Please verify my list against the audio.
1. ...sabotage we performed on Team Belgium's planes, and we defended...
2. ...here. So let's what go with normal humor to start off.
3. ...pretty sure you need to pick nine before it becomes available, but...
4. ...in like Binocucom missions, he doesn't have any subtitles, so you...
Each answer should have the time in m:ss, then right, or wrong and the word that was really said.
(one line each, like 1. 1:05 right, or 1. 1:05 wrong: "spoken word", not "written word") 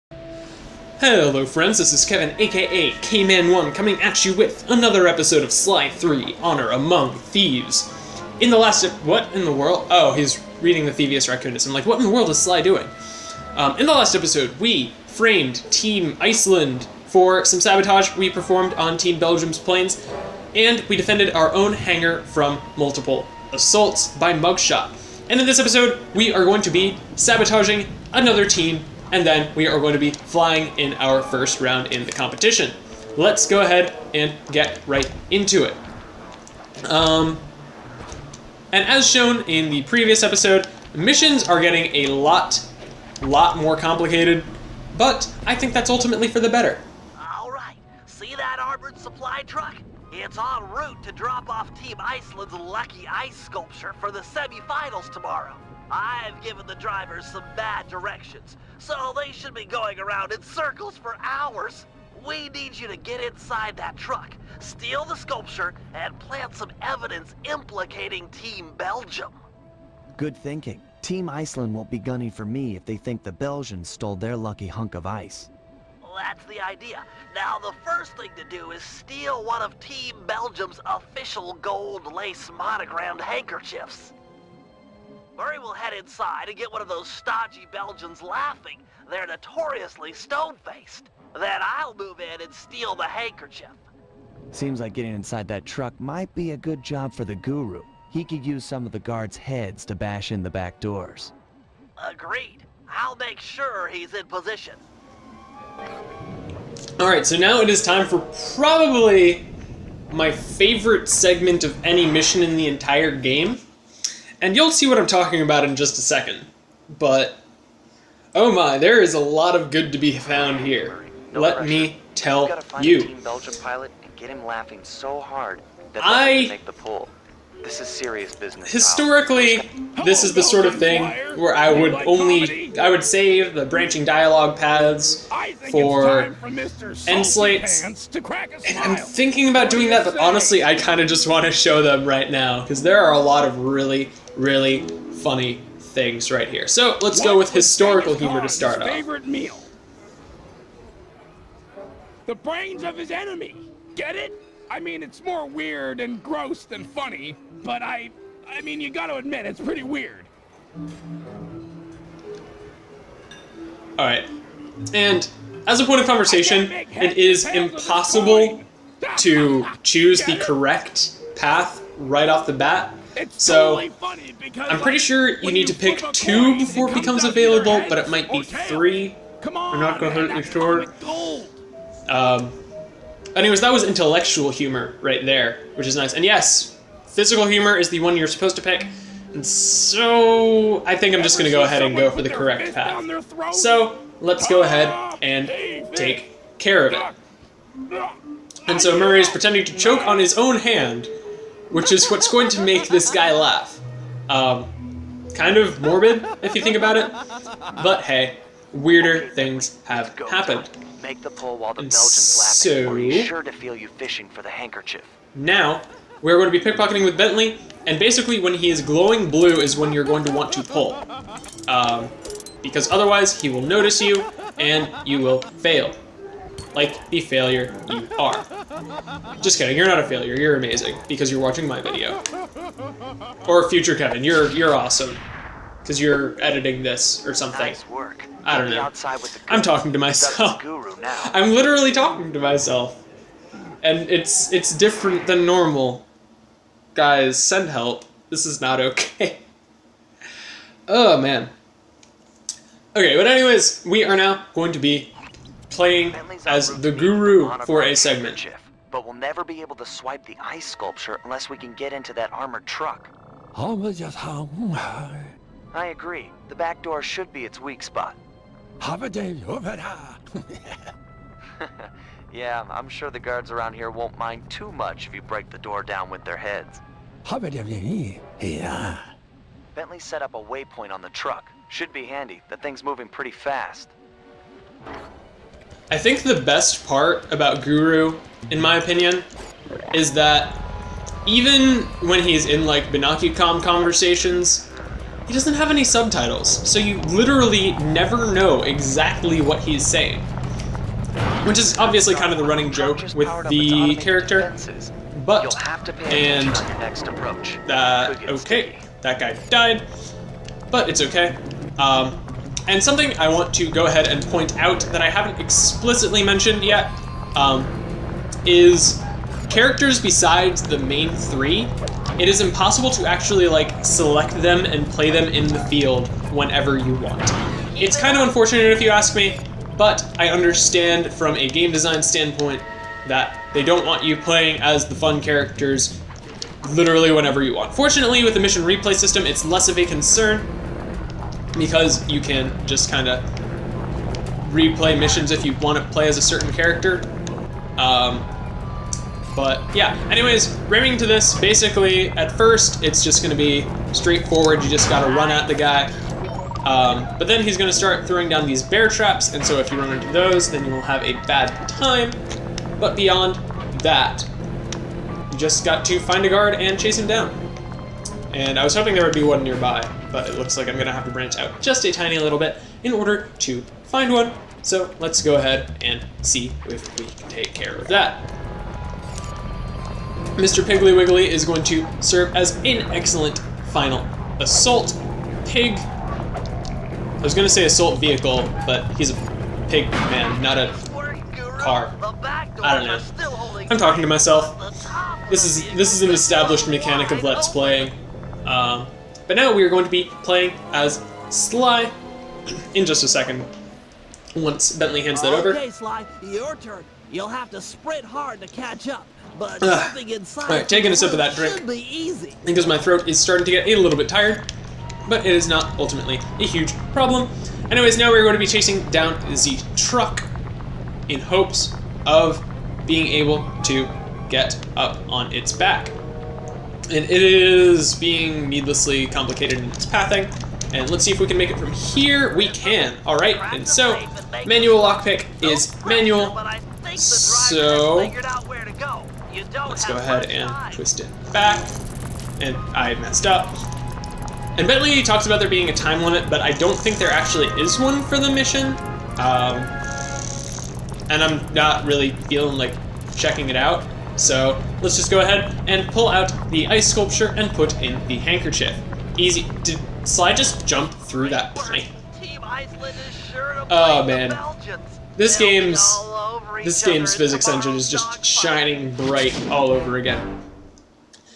1. 0:17 right
2. 2:26 wrong: "historical", not "normal"
3. 2:54 wrong: "two", not "nine"
4. 4:52 wrong: "conversations", not "missions".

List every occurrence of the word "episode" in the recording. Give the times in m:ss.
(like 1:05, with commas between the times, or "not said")
0:05, 0:14, 0:25, 0:40.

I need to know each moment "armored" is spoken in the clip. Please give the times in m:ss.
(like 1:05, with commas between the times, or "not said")
0:48, 4:22.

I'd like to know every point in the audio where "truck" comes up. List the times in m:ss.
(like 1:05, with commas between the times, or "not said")
0:49, 1:03, 1:35, 4:22, 4:41, 6:59.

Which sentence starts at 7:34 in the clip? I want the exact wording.
So let's just go ahead and pull out the ice sculpture and put in the handkerchief.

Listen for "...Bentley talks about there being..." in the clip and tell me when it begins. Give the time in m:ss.
7:24.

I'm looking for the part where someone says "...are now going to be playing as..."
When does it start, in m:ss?
4:14.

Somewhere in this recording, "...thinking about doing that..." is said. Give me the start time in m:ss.
2:18.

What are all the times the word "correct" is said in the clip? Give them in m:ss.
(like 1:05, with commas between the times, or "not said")
2:50, 3:12.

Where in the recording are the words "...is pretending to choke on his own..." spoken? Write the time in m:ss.
3:19.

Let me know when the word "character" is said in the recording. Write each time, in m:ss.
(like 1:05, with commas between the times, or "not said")
5:03, 5:19, 5:35, 5:46.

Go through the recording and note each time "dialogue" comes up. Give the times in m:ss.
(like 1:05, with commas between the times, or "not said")
2:14.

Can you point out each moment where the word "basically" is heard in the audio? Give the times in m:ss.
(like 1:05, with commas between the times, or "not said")
3:37, 5:51.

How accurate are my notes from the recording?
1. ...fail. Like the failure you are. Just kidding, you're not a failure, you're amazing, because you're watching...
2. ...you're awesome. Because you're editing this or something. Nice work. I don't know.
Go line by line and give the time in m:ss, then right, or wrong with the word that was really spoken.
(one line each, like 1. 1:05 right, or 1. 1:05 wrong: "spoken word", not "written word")
1. 3:45 right
2. 3:54 right.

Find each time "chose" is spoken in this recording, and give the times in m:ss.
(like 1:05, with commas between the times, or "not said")
not said.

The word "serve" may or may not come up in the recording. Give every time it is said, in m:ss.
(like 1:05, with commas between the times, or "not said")
6:22.